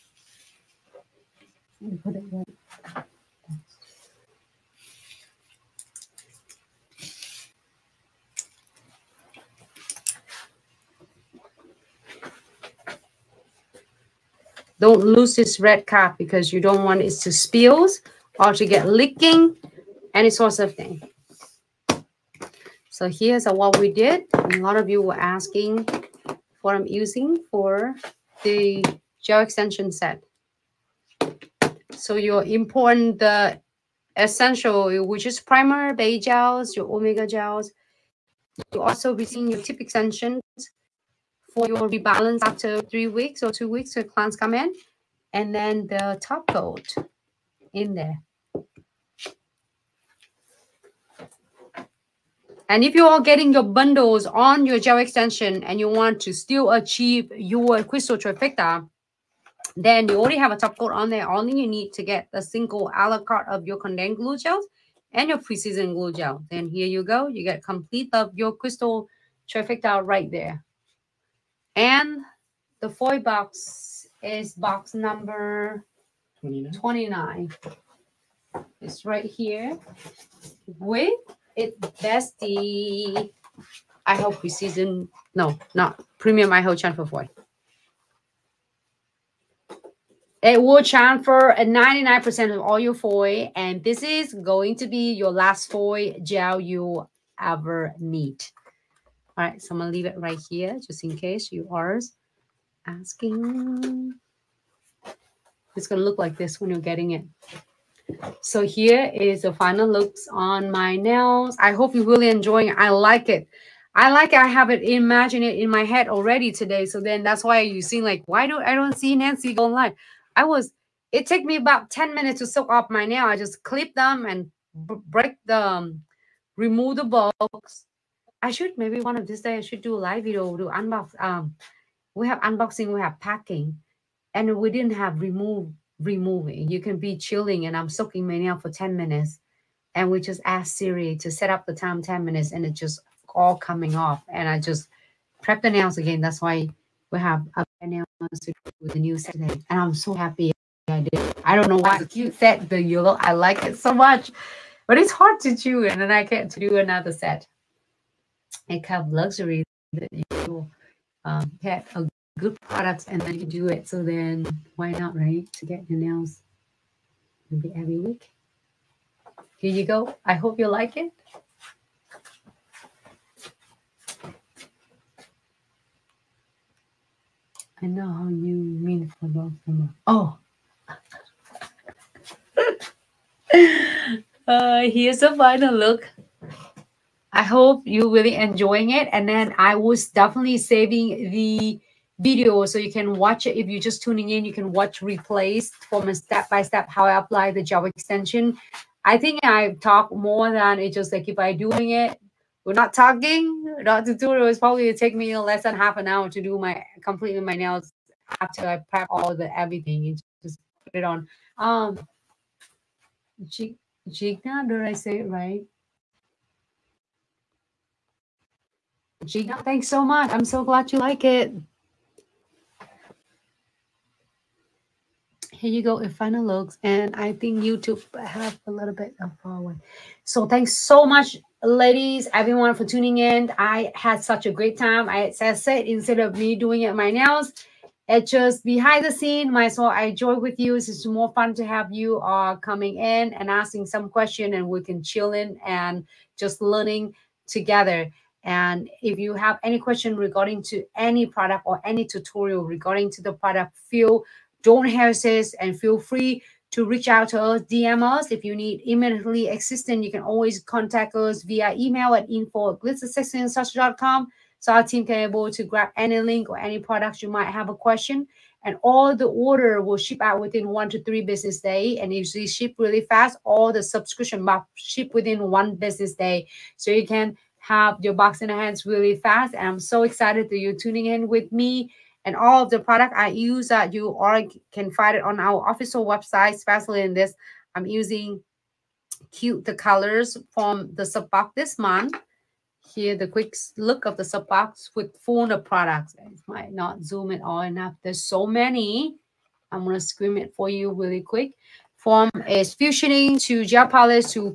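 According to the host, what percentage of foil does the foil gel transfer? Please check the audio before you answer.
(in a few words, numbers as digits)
99%.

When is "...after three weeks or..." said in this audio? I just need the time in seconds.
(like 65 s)
42 s.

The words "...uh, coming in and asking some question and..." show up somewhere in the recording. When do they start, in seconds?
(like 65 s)
242 s.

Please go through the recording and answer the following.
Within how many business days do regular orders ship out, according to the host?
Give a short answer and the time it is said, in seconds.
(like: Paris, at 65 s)
1 to 3, at 270 s.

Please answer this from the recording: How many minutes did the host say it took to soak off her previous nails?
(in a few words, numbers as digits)
10.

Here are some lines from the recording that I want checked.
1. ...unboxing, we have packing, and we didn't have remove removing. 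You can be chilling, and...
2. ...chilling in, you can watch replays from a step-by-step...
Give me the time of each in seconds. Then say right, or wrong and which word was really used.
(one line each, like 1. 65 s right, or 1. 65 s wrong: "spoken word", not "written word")
1. 132 s right
2. 194 s wrong: "tuning", not "chilling".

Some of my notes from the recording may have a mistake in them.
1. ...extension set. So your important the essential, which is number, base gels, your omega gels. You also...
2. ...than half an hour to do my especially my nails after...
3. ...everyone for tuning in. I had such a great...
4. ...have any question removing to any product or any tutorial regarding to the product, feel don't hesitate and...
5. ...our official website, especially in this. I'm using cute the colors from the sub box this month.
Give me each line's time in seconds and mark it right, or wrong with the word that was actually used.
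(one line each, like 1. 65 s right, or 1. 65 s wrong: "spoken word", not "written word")
1. 29 s wrong: "primer", not "number"
2. 205 s wrong: "completely", not "especially"
3. 232 s right
4. 249 s wrong: "regarding", not "removing"
5. 285 s right.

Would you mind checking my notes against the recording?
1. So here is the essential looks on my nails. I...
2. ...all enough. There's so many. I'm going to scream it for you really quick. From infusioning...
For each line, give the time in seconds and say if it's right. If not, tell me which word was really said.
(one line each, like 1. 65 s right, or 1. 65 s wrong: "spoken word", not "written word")
1. 108 s wrong: "final", not "essential"
2. 297 s right.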